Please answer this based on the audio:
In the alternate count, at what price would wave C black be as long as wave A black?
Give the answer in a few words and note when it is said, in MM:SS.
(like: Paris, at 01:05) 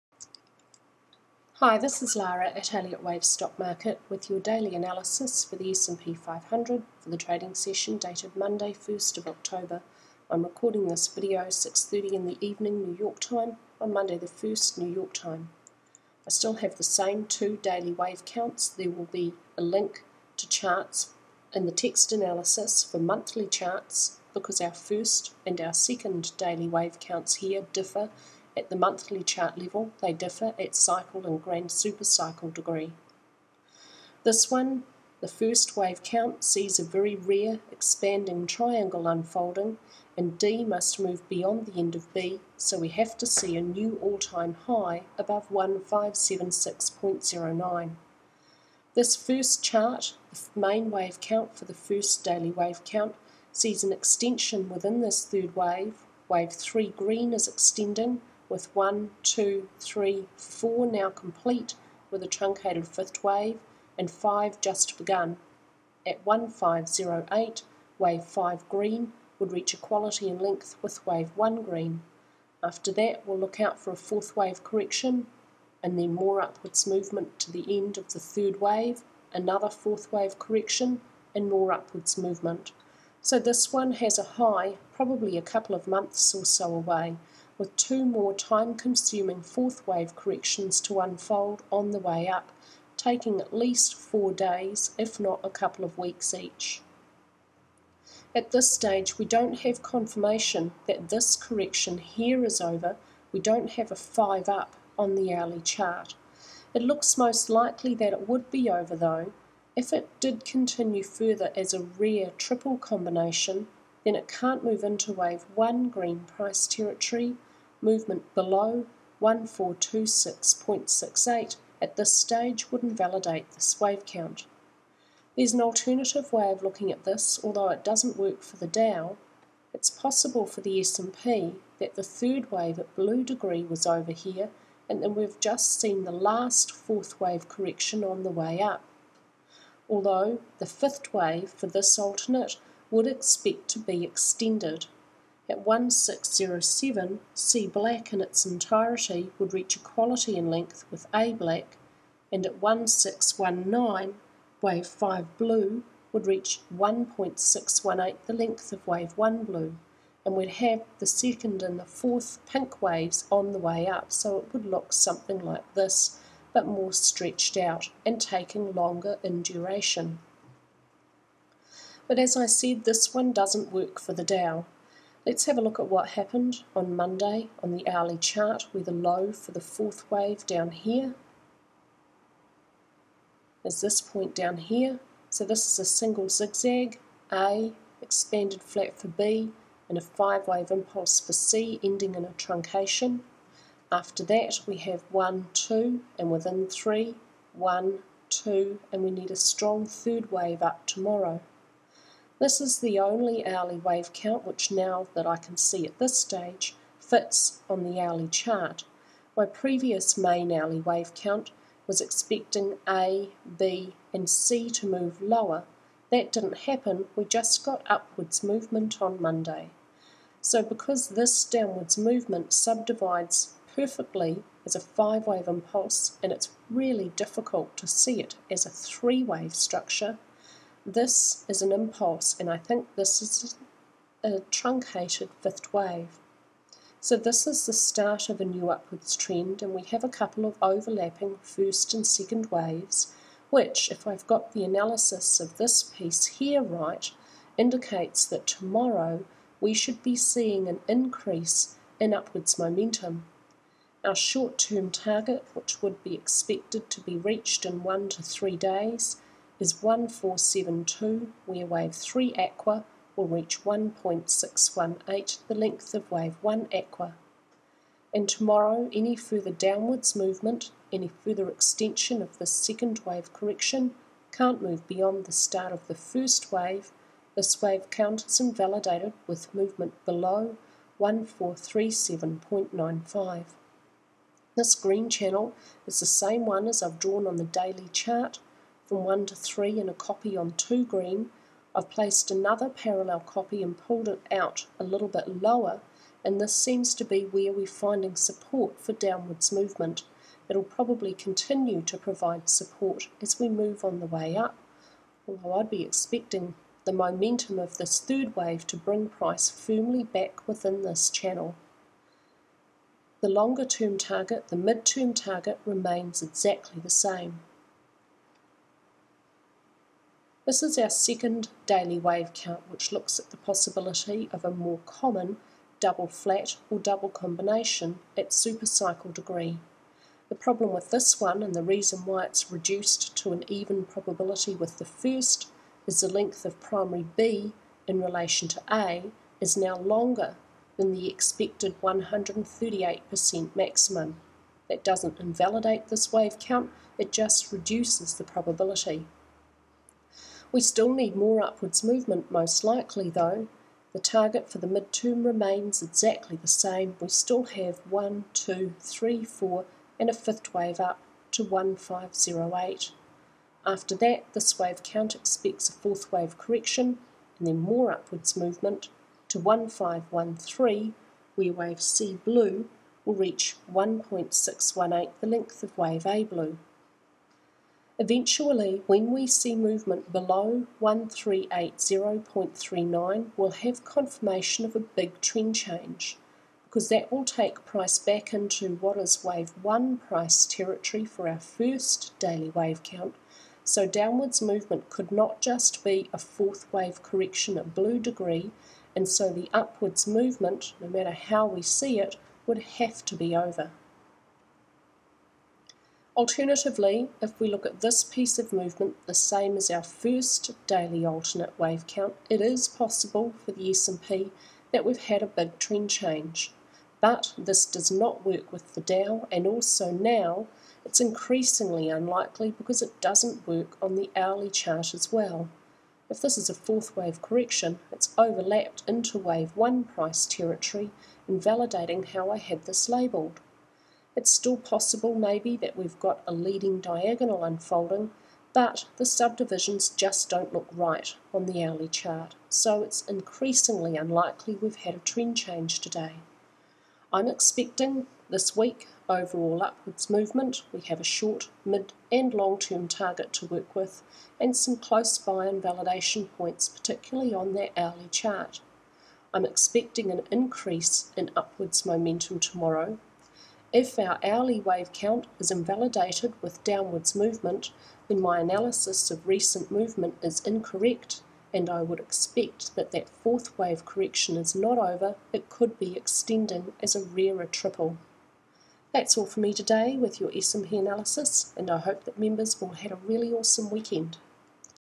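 1607, at 02:25.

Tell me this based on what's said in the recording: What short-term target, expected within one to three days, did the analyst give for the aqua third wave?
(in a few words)
1472.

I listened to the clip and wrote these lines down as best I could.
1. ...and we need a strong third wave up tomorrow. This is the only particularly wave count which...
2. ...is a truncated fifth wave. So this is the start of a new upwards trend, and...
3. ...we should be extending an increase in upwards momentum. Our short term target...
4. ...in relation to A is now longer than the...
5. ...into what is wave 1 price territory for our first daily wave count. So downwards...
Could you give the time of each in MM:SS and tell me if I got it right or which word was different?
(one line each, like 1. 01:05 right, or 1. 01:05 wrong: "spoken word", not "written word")
1. 03:18 wrong: "hourly", not "particularly"
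2. 03:53 right
3. 04:09 wrong: "seeing", not "extending"
4. 05:37 right
5. 06:28 right.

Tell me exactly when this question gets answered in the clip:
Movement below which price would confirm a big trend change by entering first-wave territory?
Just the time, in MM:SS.
06:20.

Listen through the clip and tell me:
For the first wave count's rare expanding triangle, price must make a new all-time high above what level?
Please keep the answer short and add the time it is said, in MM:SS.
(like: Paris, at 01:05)
1576.09, at 00:45.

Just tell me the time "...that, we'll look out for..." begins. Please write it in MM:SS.
01:12.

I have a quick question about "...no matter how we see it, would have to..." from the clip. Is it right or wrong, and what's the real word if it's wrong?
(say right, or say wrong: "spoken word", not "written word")
right.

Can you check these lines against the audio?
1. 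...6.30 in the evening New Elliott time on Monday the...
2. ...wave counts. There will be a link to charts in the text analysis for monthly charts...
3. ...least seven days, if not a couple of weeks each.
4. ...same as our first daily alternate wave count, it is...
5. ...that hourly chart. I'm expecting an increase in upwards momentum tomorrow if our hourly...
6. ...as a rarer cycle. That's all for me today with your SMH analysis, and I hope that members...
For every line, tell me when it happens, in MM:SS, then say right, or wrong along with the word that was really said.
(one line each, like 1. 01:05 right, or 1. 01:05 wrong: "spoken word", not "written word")
1. 00:11 wrong: "York", not "Elliott"
2. 00:17 right
3. 01:33 wrong: "four", not "seven"
4. 06:49 right
5. 07:37 right
6. 07:56 wrong: "triple", not "cycle".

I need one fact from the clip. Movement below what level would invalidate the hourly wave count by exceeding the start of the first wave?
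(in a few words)
1437.95.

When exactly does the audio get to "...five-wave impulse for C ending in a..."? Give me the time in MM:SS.
03:10.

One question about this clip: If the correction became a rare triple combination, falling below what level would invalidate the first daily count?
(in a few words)
1426.68.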